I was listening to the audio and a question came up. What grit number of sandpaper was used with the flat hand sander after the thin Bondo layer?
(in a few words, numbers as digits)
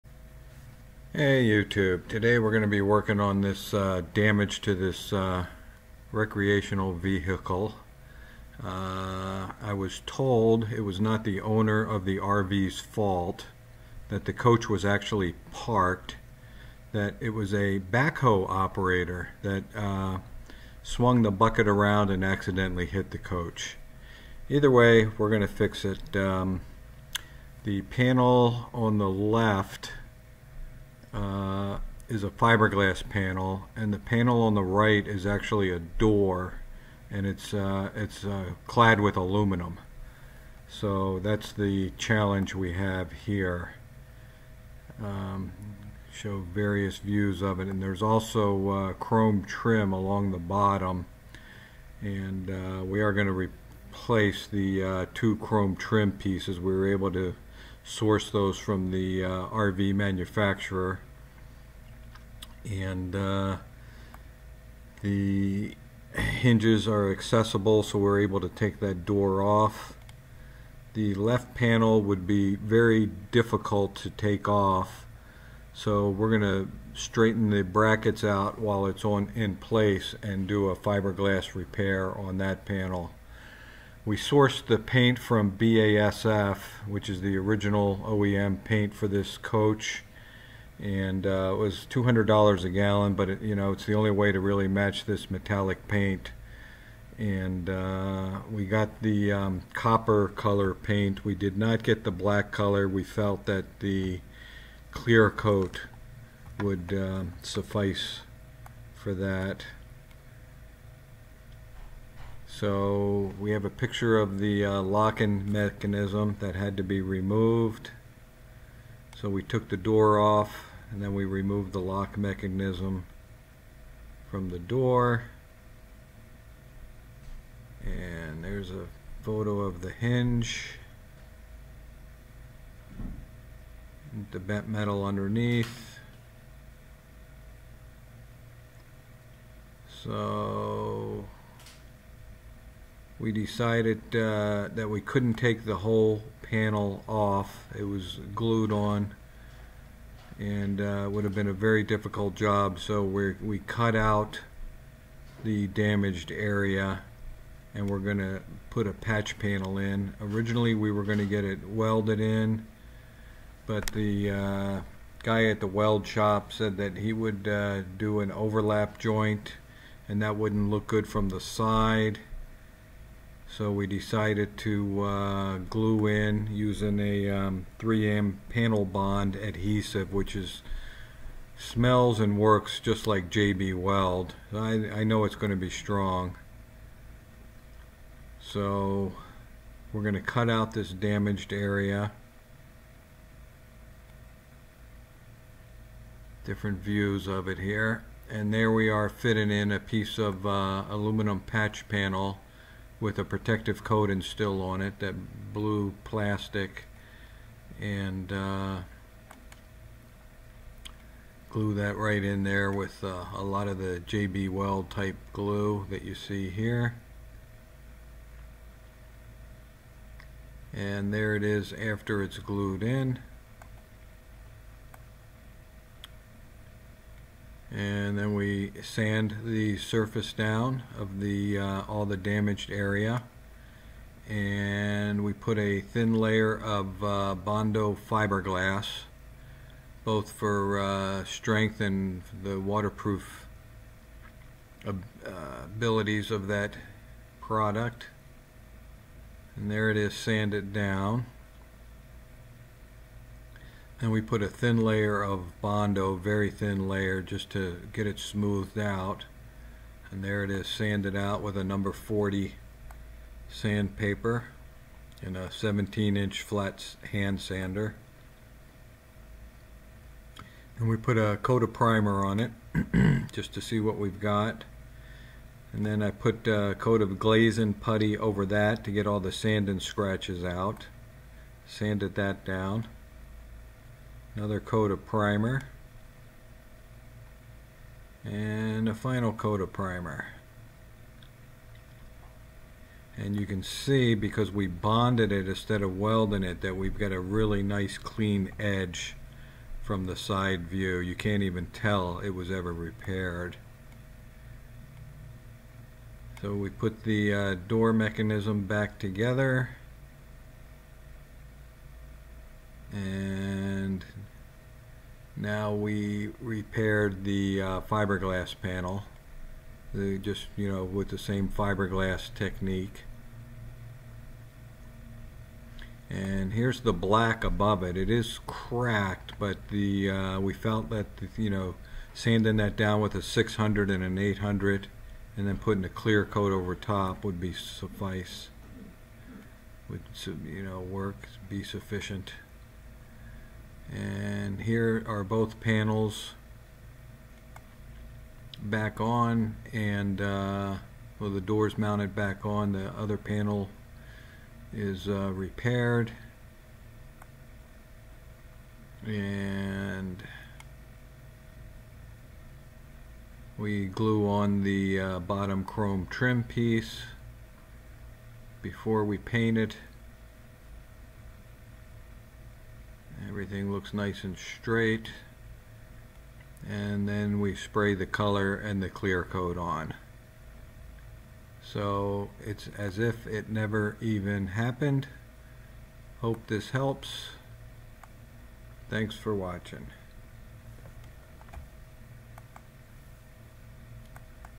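40.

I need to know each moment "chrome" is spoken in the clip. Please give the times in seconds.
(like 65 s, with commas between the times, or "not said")
48 s, 55 s, 365 s.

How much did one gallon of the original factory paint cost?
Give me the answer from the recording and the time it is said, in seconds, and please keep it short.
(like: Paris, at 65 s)
$200, at 91 s.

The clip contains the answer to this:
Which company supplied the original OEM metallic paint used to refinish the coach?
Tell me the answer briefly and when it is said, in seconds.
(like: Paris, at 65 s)
BASF, at 85 s.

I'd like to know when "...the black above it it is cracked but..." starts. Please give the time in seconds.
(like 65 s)
326 s.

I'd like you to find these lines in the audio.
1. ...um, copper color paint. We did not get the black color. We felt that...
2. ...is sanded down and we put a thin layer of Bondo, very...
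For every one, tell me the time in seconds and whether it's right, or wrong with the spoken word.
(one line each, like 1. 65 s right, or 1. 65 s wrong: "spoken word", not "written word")
1. 99 s right
2. 249 s right.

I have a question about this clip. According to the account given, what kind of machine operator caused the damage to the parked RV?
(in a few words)
Backhoe.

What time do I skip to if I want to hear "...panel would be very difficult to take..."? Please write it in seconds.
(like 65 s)
71 s.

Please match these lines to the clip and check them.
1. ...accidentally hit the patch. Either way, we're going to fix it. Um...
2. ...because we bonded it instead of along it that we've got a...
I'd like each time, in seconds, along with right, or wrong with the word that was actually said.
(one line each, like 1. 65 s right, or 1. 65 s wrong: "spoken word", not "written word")
1. 22 s wrong: "coach", not "patch"
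2. 294 s wrong: "welding", not "along".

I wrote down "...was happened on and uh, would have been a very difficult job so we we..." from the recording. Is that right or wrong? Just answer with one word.
wrong.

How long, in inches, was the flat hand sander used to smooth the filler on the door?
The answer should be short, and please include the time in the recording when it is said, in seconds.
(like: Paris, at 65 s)
17 inches, at 265 s.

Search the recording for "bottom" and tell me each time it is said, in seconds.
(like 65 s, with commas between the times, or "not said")
50 s, 365 s.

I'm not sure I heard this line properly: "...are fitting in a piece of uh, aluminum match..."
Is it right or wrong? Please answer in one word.
wrong.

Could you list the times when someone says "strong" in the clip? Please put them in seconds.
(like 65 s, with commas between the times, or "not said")
185 s.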